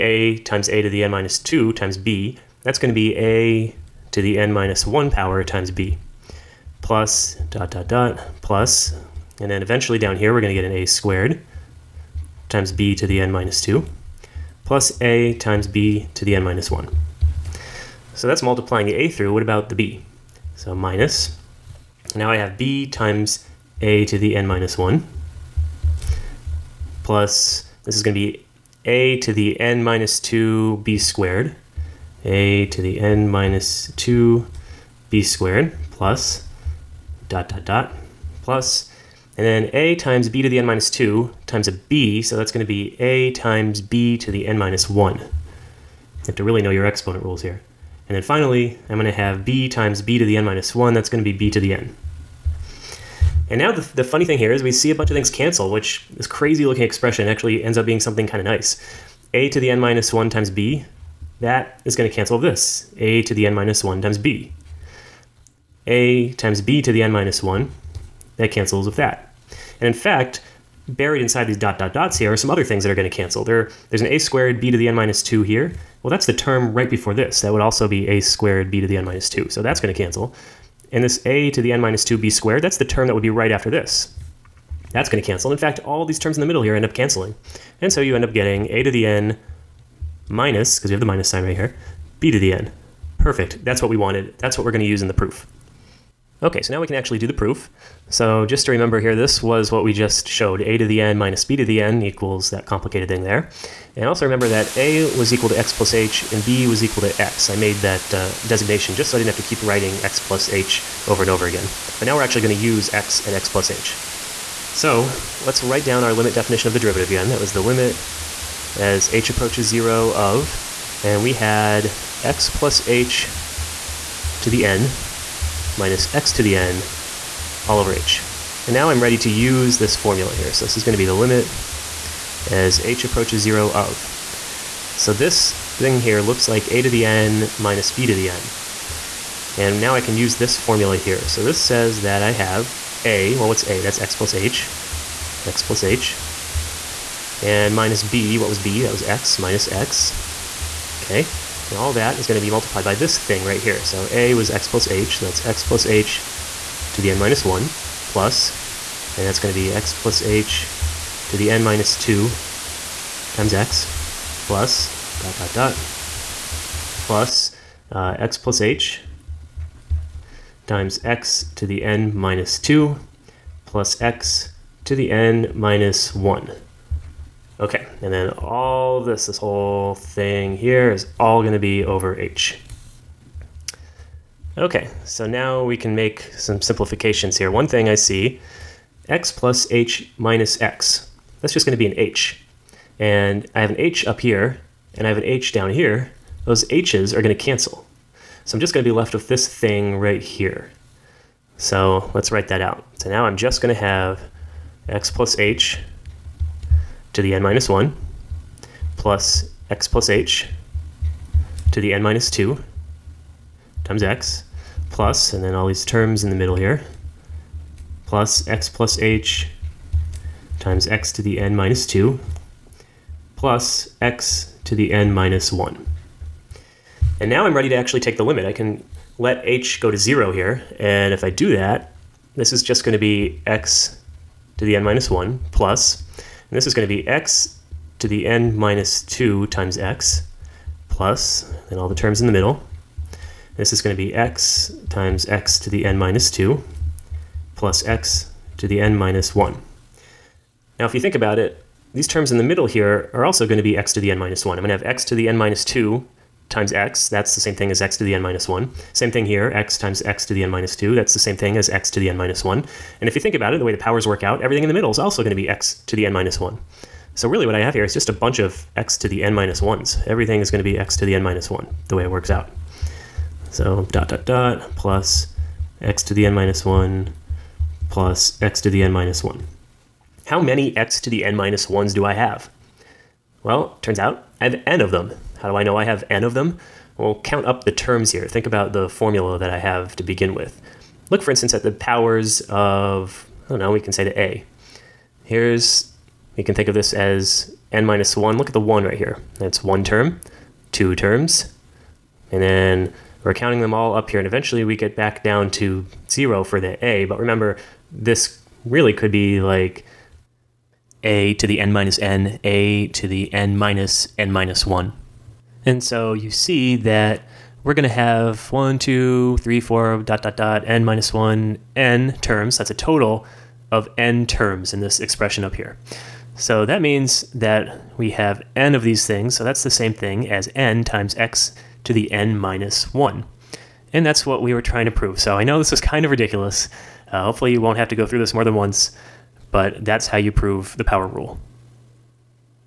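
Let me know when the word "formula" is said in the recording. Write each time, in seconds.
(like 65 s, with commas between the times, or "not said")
129 s, 140 s, 288 s.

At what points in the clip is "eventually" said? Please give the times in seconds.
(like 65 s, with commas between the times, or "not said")
9 s, 304 s.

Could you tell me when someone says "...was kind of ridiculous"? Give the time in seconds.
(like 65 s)
335 s.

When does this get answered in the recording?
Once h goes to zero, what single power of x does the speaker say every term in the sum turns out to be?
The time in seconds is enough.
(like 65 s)
270 s.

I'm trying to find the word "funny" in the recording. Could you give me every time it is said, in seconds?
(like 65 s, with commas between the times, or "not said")
54 s.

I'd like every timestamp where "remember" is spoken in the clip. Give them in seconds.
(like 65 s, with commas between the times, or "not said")
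98 s, 104 s, 307 s.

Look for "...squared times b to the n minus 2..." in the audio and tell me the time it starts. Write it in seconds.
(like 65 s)
10 s.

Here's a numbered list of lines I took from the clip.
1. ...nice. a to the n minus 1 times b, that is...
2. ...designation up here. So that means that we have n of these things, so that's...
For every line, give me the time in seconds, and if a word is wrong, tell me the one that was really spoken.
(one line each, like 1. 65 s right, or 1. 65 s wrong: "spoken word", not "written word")
1. 58 s right
2. 324 s wrong: "expression", not "designation".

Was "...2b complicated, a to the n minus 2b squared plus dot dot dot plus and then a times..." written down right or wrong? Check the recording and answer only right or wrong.
wrong.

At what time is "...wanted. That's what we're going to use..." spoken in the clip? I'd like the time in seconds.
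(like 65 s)
93 s.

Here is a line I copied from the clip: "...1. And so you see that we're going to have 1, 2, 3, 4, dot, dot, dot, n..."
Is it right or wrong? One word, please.
right.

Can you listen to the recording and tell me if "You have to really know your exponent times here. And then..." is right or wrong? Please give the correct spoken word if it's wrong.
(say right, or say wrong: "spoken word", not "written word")
wrong: "rules", not "times".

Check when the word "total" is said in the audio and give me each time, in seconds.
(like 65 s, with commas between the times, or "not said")
322 s.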